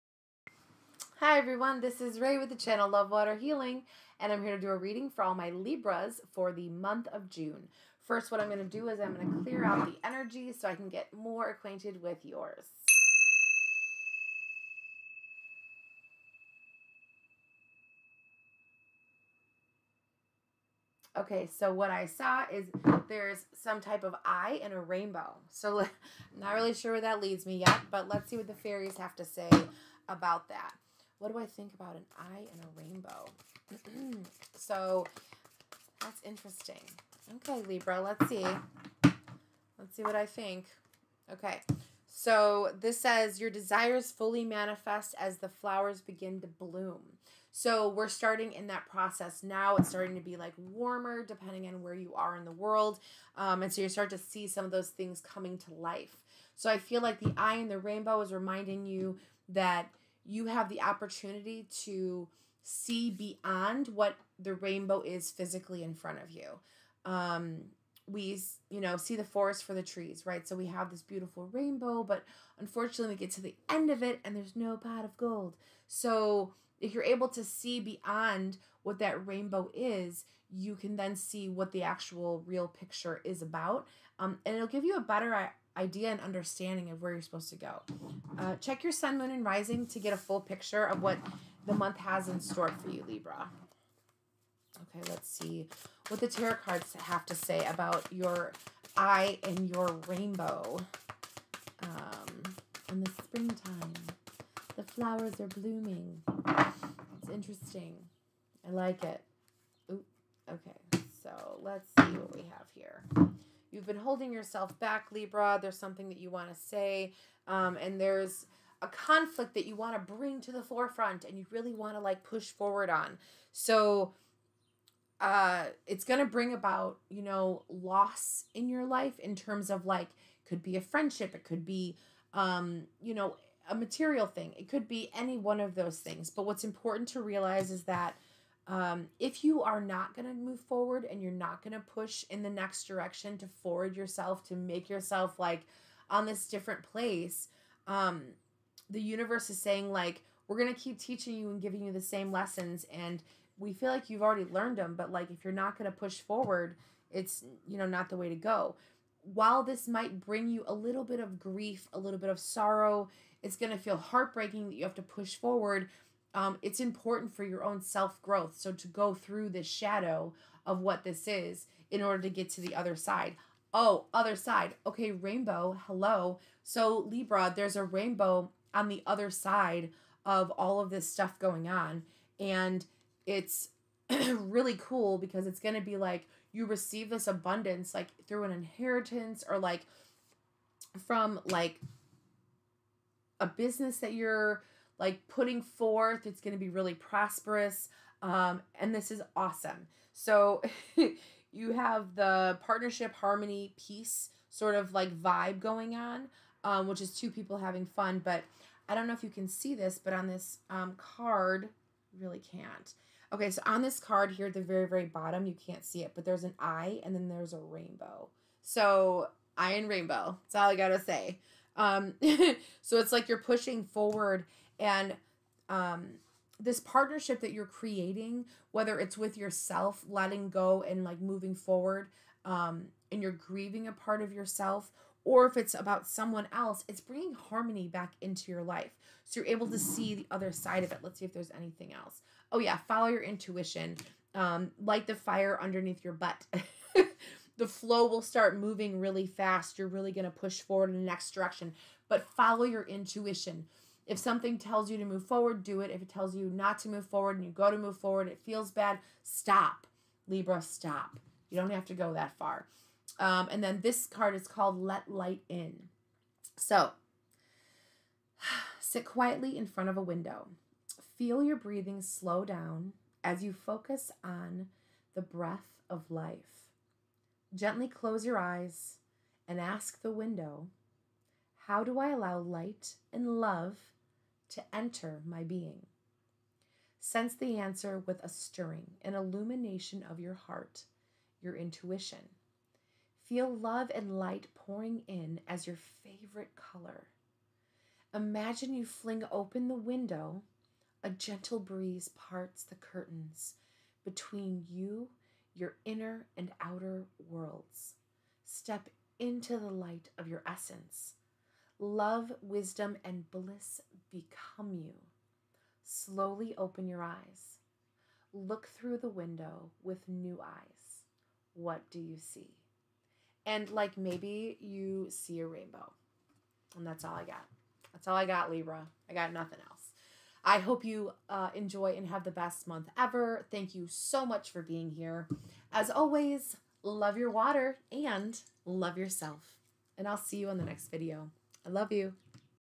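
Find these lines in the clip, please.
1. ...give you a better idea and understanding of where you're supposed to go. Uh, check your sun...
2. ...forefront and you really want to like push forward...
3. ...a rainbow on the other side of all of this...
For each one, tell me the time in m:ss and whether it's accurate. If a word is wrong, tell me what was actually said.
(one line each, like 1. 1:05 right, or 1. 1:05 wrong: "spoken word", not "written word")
1. 1:24 right
2. 2:00 right
3. 2:57 right.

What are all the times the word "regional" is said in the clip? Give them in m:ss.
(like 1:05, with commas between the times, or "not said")
not said.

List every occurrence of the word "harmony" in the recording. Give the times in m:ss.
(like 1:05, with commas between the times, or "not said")
3:23, 3:57.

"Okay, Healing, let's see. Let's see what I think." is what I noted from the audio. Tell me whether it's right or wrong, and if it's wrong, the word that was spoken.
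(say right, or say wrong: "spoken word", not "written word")
wrong: "Libra", not "Healing".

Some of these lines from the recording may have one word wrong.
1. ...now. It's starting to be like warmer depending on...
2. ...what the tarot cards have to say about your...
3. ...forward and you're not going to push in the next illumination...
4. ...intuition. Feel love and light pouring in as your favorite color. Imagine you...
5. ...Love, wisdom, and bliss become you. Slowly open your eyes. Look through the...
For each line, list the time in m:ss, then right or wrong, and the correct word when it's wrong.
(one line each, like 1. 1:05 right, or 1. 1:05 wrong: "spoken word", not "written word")
1. 0:49 right
2. 1:36 right
3. 2:20 wrong: "direction", not "illumination"
4. 4:51 right
5. 5:11 right.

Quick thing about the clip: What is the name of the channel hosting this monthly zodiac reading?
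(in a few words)
Love Water Healing.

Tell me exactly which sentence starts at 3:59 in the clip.
So you're able to see the other side of it.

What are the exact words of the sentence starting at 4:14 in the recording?
If something tells you to move forward, do it.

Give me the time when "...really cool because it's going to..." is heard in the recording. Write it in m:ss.
3:04.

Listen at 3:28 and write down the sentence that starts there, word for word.
But I don't know if you can see this, but on this um, card, really can't.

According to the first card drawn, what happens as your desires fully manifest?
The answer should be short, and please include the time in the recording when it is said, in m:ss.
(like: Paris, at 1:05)
The flowers begin to bloom, at 0:45.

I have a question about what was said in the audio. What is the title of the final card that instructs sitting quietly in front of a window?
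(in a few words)
Let Light In.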